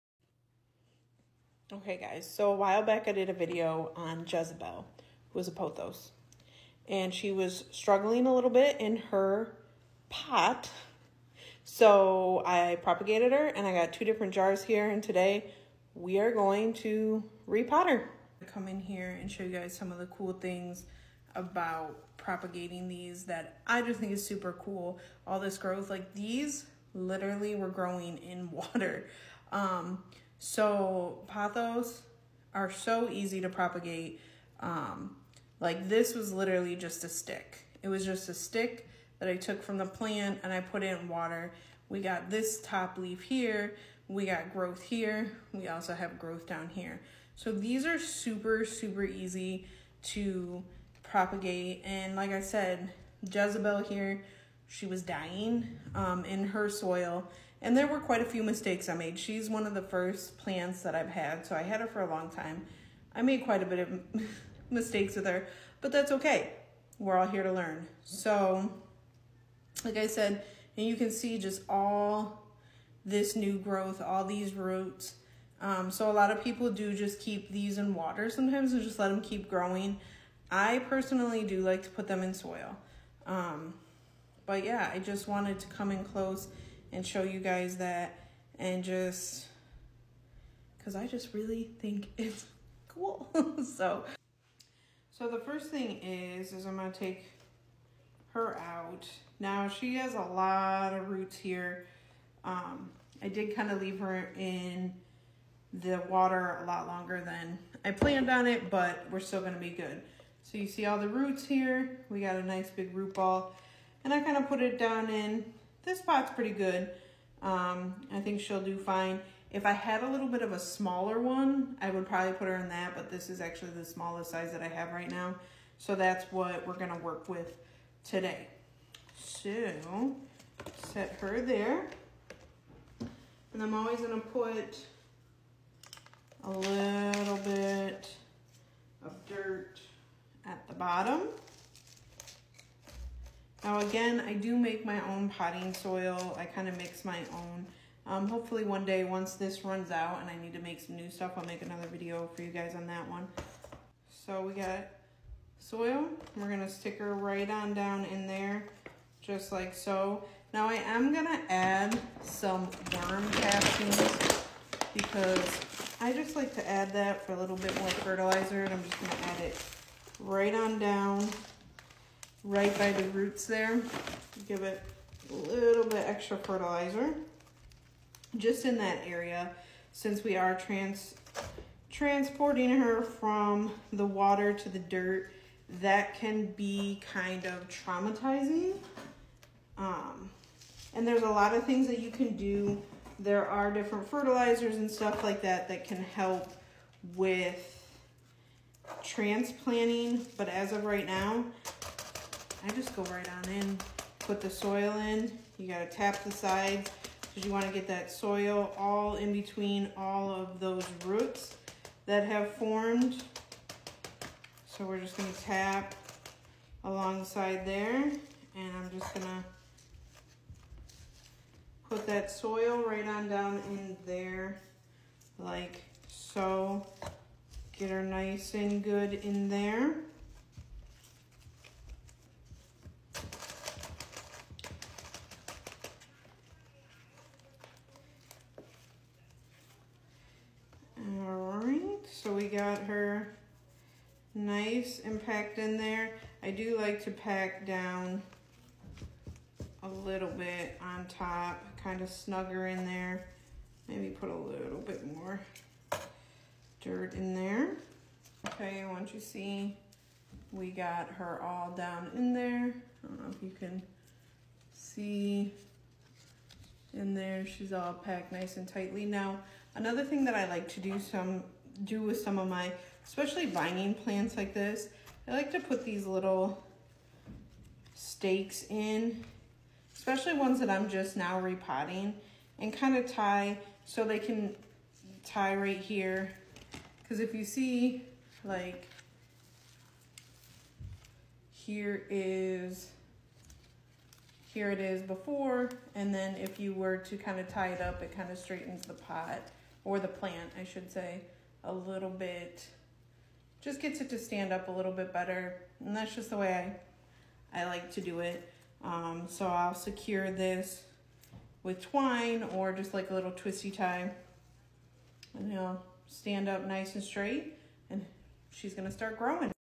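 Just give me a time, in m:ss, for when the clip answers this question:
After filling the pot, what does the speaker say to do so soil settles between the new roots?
3:25.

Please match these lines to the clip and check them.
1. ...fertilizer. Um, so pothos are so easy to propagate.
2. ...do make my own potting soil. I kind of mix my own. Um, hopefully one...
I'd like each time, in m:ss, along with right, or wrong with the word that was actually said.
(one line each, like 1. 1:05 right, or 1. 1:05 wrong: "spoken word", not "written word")
1. 0:28 wrong: "water", not "fertilizer"
2. 2:24 right.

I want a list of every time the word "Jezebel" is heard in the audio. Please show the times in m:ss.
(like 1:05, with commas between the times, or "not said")
0:04, 0:53.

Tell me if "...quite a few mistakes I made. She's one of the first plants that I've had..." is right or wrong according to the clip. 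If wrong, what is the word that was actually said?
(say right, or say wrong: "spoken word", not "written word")
right.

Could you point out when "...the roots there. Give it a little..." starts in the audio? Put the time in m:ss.
2:52.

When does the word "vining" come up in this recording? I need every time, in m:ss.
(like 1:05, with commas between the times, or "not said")
4:33.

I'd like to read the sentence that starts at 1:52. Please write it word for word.
We got a nice big root ball and I kind of put it down in this pot's pretty good.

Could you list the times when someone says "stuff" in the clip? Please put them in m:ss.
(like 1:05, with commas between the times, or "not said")
2:31, 3:14.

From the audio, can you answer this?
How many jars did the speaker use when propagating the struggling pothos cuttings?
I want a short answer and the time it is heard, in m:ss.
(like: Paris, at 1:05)
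2, at 0:13.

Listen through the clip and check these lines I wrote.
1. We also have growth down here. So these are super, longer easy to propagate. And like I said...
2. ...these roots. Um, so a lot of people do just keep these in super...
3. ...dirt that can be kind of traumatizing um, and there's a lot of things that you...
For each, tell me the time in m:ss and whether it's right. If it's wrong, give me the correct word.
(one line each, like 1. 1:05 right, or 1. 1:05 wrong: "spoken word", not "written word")
1. 0:45 wrong: "super", not "longer"
2. 1:14 wrong: "water", not "super"
3. 3:04 right.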